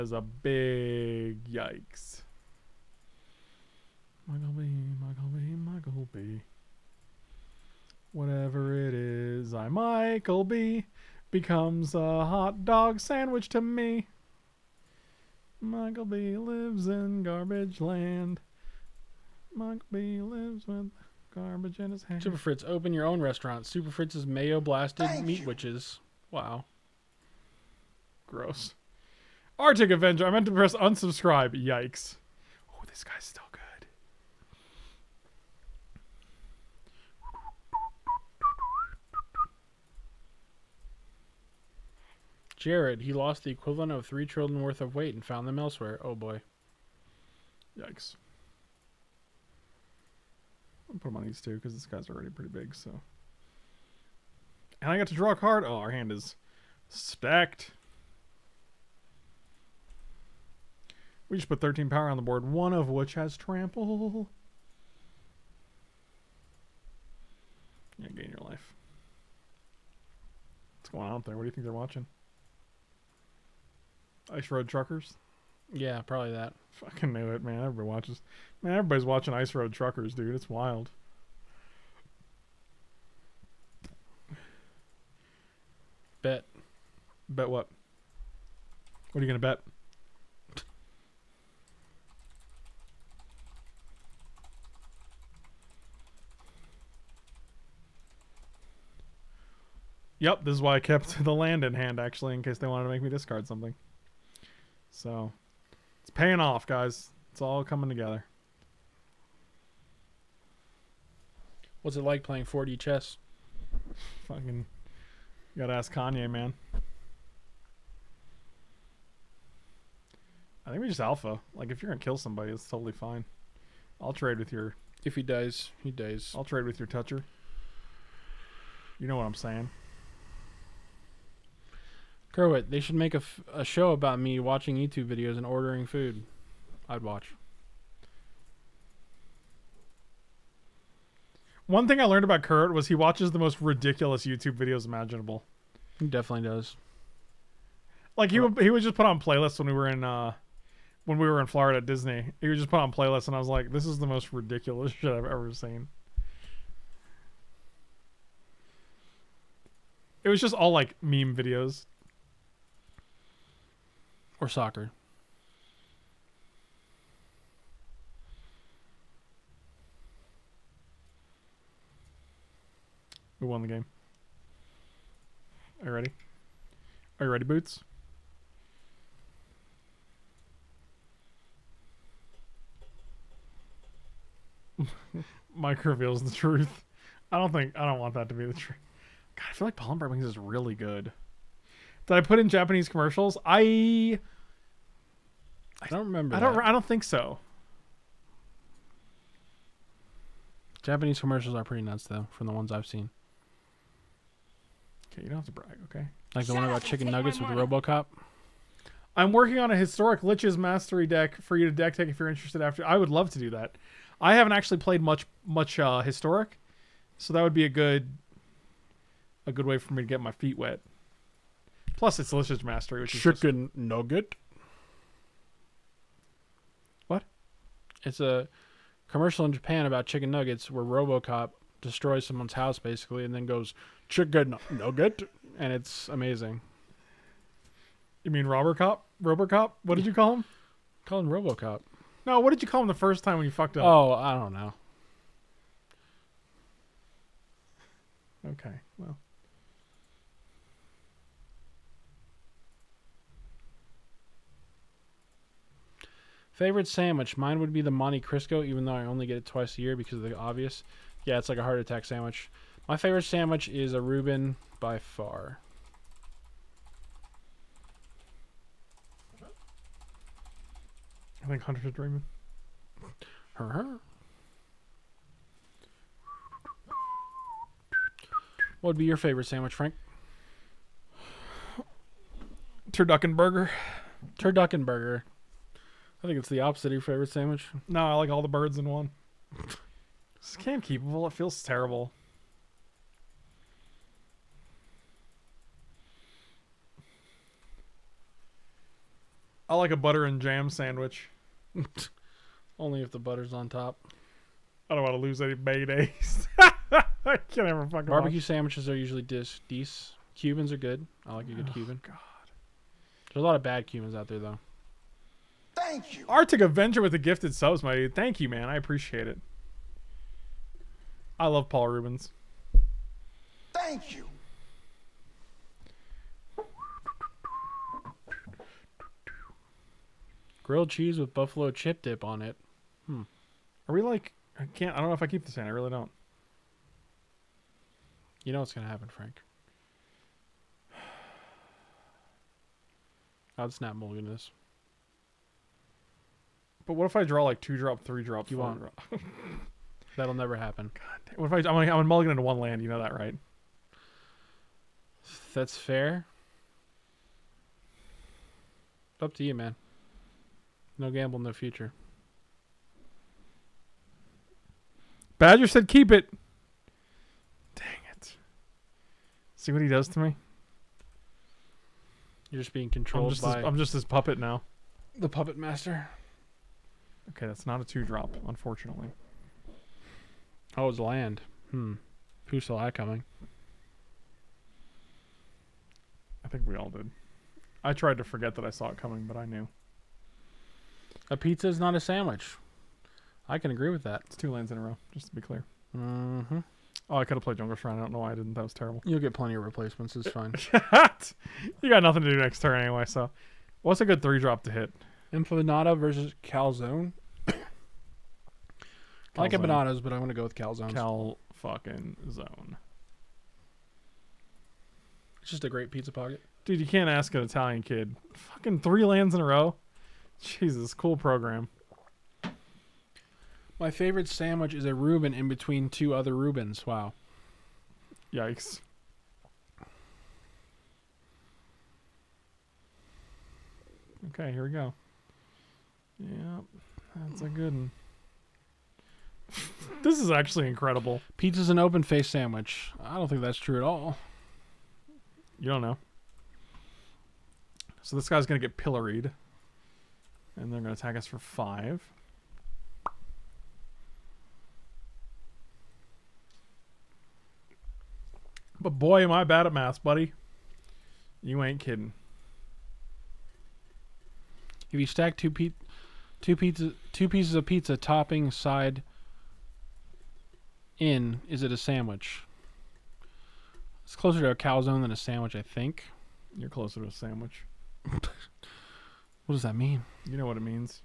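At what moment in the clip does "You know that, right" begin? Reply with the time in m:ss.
5:52.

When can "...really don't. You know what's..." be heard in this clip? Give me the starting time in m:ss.
5:35.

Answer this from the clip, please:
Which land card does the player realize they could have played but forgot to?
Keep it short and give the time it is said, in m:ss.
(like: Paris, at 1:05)
Jungle Shrine, at 6:37.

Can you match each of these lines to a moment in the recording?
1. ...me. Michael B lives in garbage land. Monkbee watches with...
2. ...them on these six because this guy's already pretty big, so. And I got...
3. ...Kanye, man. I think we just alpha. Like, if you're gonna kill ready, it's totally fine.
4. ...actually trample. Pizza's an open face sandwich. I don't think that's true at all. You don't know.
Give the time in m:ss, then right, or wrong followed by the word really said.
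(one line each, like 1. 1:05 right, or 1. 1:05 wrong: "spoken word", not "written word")
1. 0:13 wrong: "lives", not "watches"
2. 0:51 wrong: "two", not "six"
3. 1:55 wrong: "somebody", not "ready"
4. 7:20 wrong: "incredible", not "trample".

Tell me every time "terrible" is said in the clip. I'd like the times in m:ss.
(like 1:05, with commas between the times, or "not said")
4:51, 6:38.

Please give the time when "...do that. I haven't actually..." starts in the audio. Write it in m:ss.
3:33.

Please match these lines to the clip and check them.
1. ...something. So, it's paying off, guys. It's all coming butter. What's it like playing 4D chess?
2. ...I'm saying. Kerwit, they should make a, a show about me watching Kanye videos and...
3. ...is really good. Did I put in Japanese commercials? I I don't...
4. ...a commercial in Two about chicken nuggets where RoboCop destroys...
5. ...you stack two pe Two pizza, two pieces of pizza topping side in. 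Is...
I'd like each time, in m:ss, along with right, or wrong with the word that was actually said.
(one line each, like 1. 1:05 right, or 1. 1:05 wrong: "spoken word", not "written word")
1. 1:43 wrong: "together", not "butter"
2. 2:09 wrong: "YouTube", not "Kanye"
3. 3:10 right
4. 3:48 wrong: "Japan", not "Two"
5. 7:44 right.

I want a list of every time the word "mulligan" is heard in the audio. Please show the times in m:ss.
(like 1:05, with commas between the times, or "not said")
5:43, 5:52.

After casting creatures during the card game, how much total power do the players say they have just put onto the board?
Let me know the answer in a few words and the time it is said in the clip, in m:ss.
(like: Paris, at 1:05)
13, at 1:01.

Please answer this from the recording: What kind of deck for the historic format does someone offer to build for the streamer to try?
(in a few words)
Lich's Mastery.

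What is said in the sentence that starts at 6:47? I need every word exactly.
I like empanadas, but I'm gonna go with calzone.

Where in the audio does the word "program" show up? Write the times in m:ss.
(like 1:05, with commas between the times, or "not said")
7:01.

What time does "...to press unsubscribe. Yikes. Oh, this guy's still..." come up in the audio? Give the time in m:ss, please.
0:30.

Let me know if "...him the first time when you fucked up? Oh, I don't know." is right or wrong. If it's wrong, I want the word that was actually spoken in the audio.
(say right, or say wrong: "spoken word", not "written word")
right.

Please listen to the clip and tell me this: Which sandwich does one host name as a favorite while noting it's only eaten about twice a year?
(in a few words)
Monte Cristo.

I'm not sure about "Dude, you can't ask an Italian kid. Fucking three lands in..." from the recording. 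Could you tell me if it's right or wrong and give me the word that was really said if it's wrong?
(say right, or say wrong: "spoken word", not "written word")
right.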